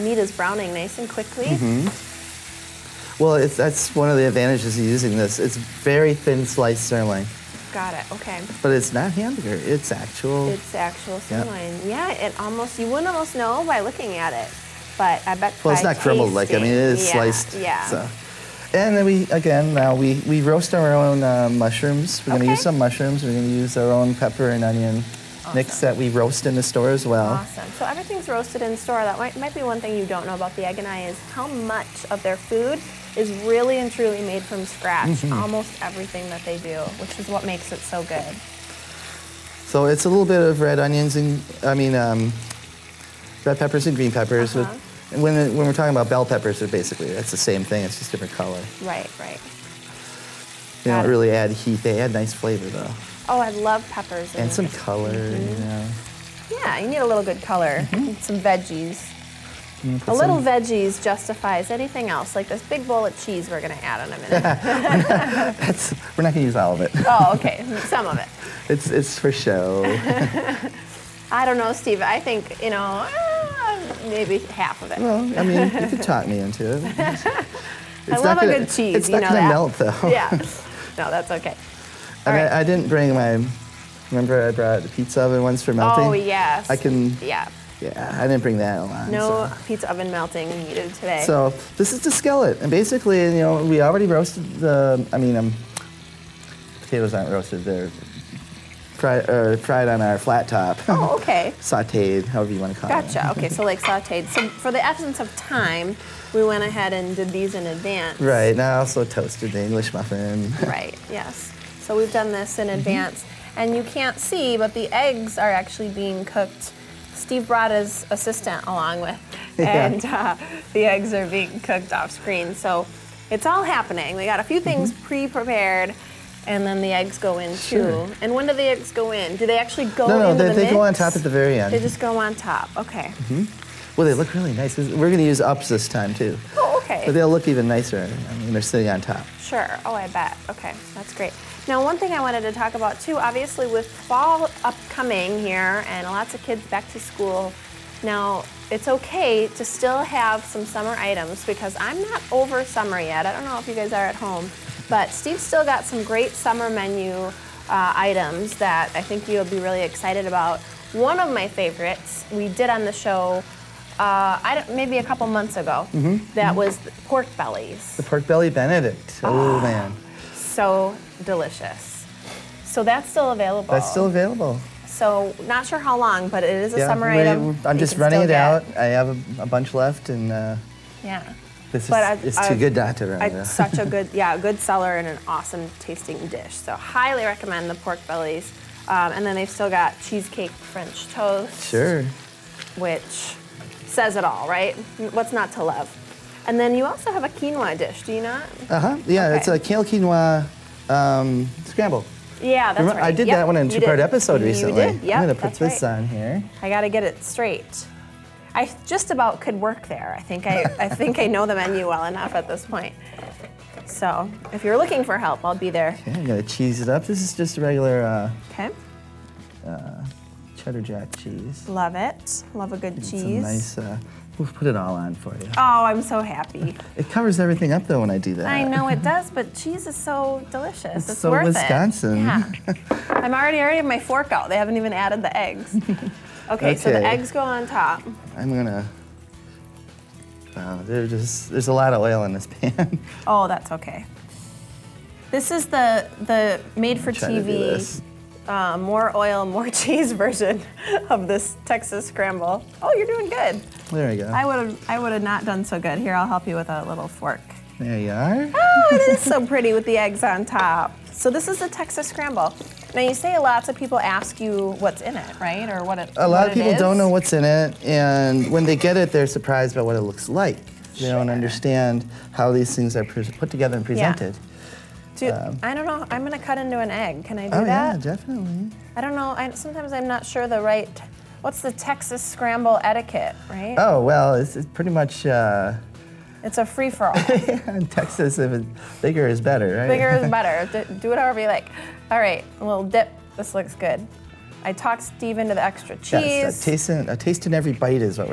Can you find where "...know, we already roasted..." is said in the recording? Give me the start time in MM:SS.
01:33.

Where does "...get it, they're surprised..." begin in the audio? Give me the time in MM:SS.
04:28.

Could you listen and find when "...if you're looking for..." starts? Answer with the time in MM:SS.
03:34.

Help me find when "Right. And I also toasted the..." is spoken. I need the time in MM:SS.
01:48.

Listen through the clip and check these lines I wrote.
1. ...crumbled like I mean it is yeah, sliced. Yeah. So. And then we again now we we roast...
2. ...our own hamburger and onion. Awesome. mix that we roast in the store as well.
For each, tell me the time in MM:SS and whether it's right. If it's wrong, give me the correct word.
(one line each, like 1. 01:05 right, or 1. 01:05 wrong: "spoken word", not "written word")
1. 00:15 right
2. 00:23 wrong: "pepper", not "hamburger".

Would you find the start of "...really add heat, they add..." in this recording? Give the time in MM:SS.
00:51.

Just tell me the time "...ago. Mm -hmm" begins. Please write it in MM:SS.
02:45.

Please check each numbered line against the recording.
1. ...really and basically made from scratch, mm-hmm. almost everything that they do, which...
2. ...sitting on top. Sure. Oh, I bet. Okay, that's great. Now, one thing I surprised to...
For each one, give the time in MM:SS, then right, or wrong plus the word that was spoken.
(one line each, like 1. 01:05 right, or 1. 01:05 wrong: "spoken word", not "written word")
1. 00:33 wrong: "truly", not "basically"
2. 02:18 wrong: "wanted", not "surprised".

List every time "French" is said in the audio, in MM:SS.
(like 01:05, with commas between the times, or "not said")
03:10.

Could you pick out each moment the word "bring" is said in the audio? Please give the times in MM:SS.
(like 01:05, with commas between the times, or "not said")
01:22, 01:28.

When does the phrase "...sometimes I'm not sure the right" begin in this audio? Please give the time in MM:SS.
04:39.